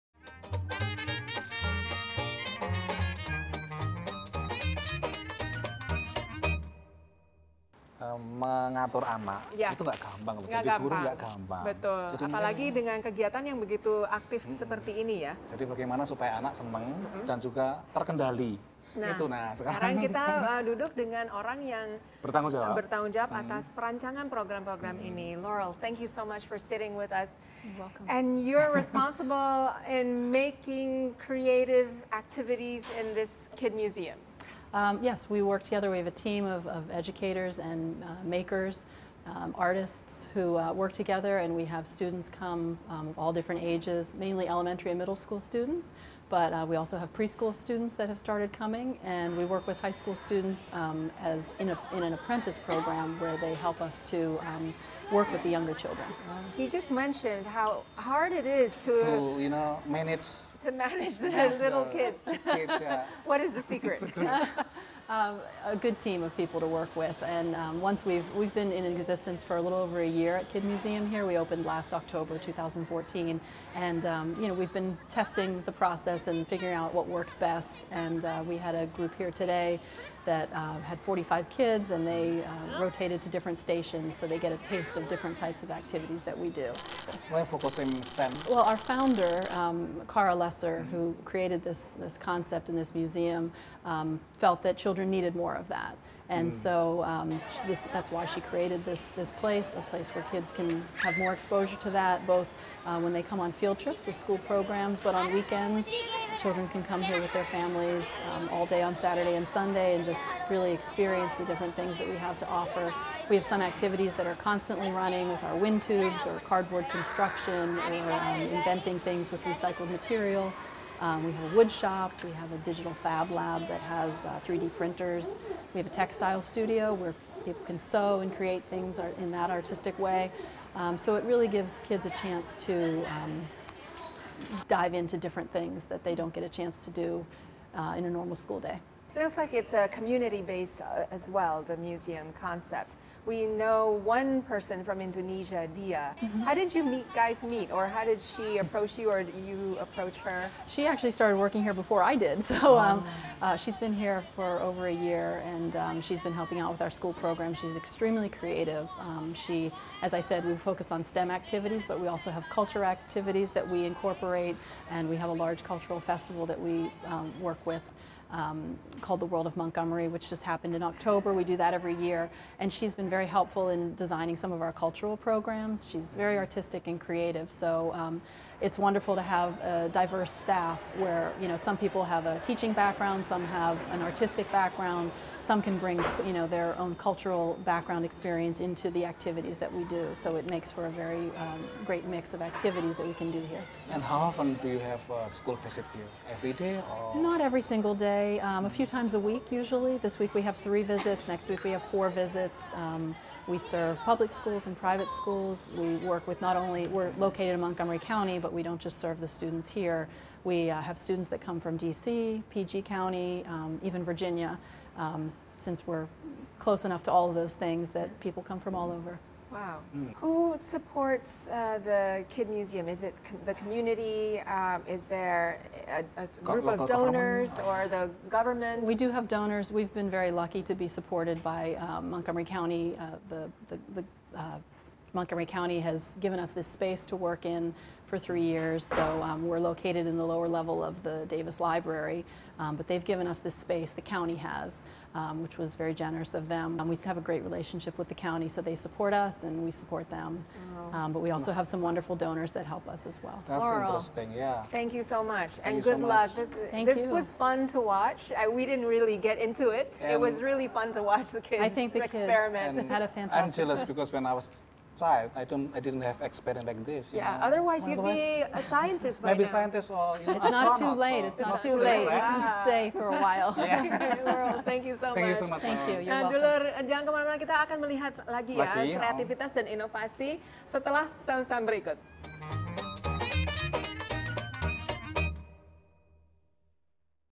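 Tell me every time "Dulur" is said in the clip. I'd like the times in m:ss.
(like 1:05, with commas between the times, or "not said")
4:36.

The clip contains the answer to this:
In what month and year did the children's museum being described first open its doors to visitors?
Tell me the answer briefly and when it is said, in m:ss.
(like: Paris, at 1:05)
October 2014, at 1:11.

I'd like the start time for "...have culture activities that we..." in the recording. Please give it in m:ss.
2:42.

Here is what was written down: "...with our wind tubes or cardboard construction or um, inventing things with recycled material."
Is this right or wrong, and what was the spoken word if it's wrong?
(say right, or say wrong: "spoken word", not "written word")
right.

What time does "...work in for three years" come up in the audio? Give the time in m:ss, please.
3:57.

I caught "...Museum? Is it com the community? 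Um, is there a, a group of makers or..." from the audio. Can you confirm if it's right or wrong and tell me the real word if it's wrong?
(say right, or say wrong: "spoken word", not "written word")
wrong: "donors", not "makers".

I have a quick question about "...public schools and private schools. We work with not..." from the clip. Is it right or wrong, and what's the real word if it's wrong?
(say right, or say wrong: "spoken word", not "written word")
right.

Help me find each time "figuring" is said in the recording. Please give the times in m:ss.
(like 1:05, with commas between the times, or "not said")
1:16.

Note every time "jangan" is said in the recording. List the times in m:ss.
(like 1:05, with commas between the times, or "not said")
4:36.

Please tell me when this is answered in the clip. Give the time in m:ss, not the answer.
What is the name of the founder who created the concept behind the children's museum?
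1:30.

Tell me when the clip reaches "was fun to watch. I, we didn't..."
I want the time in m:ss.
4:17.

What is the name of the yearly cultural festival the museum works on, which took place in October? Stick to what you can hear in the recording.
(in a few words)
The World of Montgomery.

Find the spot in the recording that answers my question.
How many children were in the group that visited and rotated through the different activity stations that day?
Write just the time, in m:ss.
1:21.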